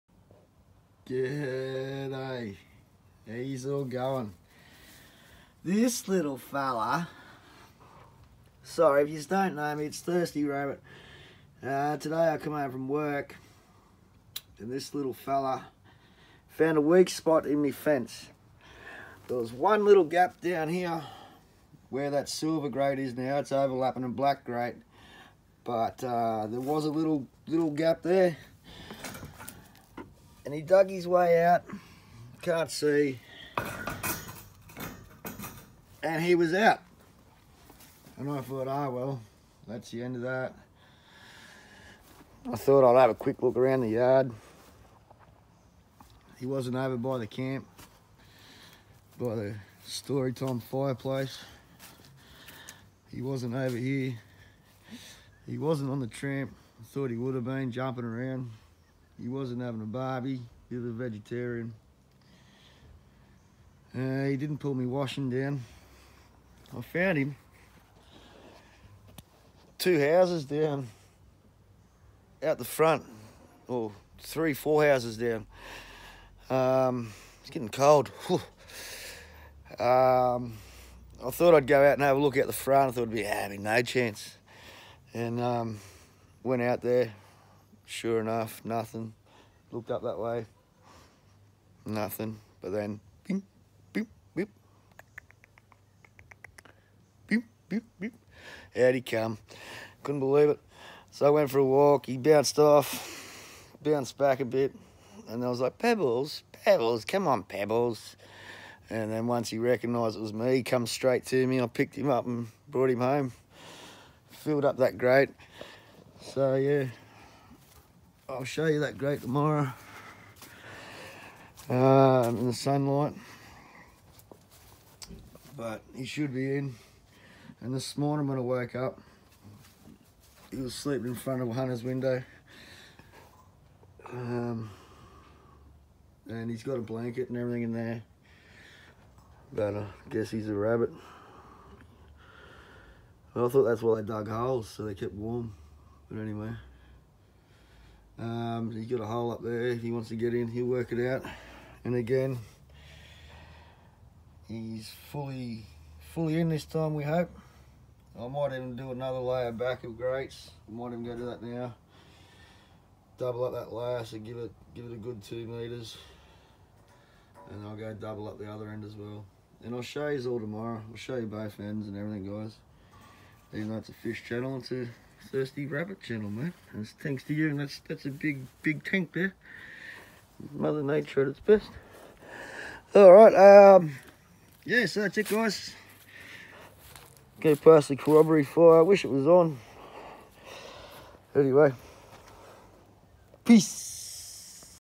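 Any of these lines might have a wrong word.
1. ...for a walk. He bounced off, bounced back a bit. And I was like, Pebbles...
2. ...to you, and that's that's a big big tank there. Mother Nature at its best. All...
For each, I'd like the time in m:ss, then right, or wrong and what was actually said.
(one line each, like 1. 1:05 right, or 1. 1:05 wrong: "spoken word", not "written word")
1. 1:41 right
2. 2:57 right.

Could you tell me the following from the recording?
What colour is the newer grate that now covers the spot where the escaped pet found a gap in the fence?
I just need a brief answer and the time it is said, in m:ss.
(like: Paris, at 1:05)
Silver, at 0:22.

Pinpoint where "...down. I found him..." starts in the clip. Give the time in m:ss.
1:05.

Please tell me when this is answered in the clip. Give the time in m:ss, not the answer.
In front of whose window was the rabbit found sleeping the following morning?
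2:11.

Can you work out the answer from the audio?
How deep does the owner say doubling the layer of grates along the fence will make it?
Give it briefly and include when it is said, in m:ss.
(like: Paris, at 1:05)
2 meters, at 2:45.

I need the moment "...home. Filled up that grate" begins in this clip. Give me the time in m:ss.
1:53.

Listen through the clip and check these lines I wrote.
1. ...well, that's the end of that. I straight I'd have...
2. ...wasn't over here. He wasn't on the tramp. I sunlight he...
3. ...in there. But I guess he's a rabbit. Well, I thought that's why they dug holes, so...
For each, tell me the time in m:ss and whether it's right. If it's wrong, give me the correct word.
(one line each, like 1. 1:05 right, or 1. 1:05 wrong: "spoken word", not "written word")
1. 0:38 wrong: "thought", not "straight"
2. 0:53 wrong: "thought", not "sunlight"
3. 2:17 right.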